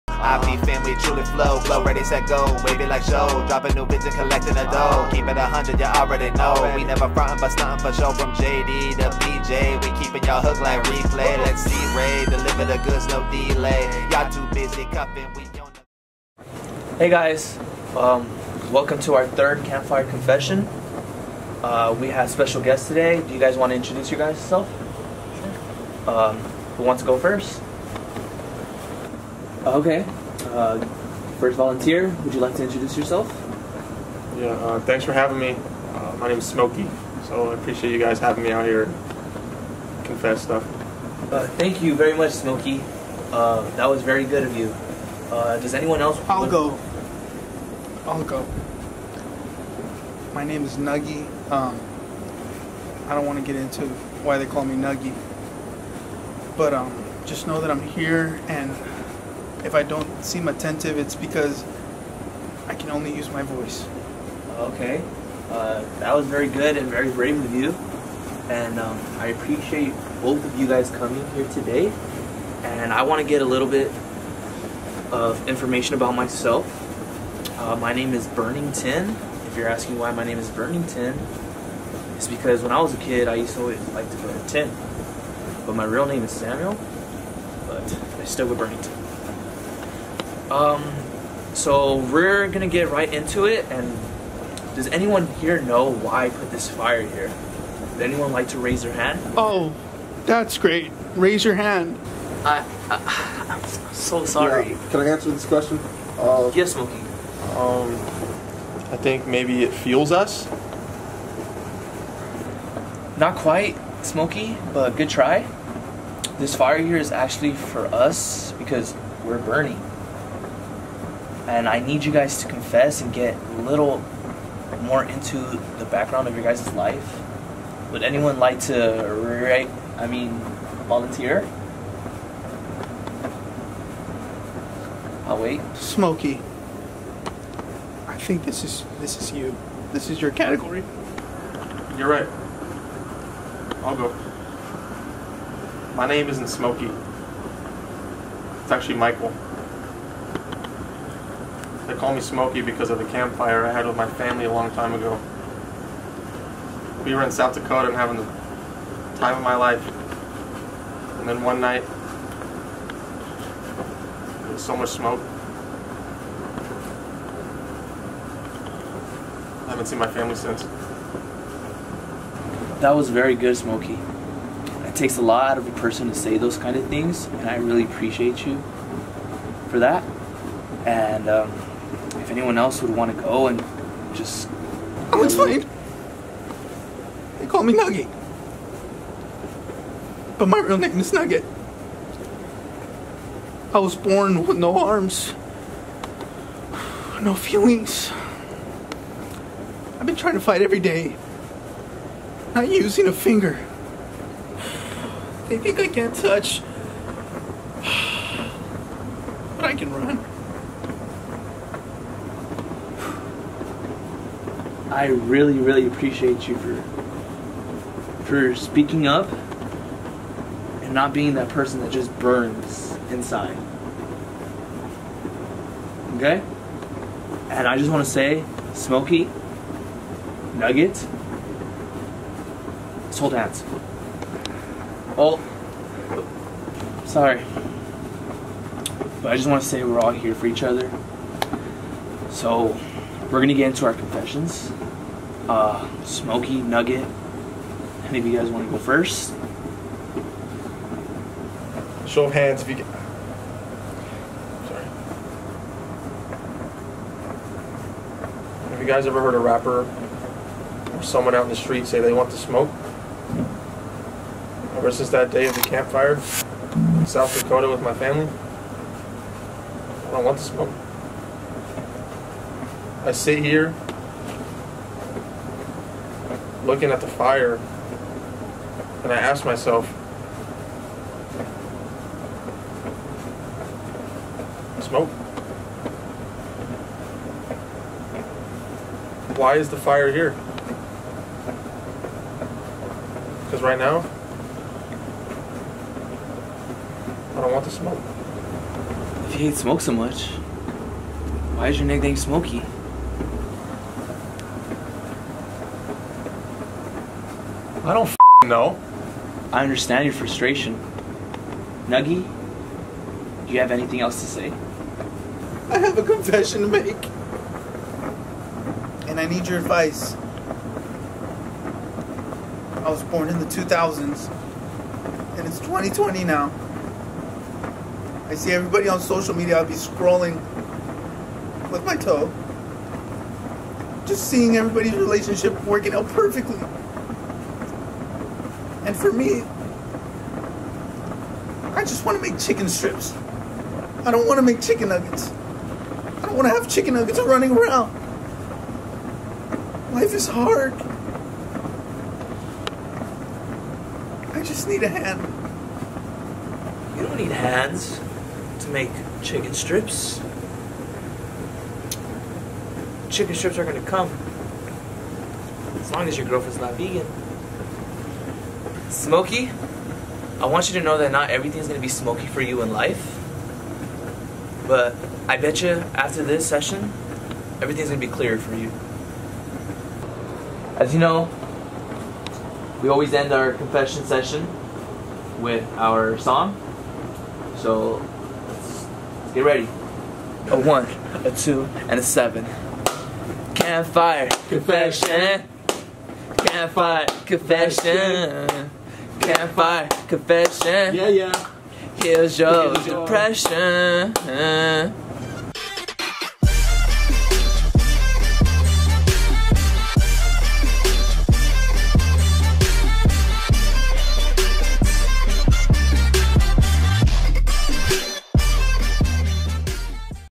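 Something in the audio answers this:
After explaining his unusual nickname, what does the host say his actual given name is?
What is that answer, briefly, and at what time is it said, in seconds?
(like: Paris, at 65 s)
Samuel, at 86 s.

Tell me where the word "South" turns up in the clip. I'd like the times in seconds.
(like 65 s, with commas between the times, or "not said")
157 s, 267 s.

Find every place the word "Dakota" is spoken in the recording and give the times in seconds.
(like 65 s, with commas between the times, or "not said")
157 s, 267 s.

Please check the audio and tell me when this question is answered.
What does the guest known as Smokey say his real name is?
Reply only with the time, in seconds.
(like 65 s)
148 s.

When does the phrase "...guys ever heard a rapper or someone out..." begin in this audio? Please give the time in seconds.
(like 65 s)
258 s.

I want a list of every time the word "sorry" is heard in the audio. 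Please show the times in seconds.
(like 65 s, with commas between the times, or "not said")
104 s, 237 s, 254 s.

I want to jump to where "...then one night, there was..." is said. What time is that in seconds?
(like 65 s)
161 s.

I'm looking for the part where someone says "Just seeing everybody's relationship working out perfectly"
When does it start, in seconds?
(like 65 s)
334 s.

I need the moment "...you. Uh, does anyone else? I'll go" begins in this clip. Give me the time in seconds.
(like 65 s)
44 s.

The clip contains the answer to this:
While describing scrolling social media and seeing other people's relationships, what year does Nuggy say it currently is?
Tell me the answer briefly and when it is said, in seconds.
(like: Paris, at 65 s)
2020, at 325 s.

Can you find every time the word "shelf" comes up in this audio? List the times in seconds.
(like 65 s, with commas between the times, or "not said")
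not said.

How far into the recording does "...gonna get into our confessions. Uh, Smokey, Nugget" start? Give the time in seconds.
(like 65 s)
243 s.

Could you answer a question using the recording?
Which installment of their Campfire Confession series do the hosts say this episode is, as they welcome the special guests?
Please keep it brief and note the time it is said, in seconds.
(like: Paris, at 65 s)
third, at 19 s.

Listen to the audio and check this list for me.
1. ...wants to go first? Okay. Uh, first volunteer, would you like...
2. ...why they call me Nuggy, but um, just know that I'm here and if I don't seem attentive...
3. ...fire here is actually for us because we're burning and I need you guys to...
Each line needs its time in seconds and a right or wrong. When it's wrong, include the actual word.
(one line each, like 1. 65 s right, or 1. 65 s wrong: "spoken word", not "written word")
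1. 26 s right
2. 54 s right
3. 116 s right.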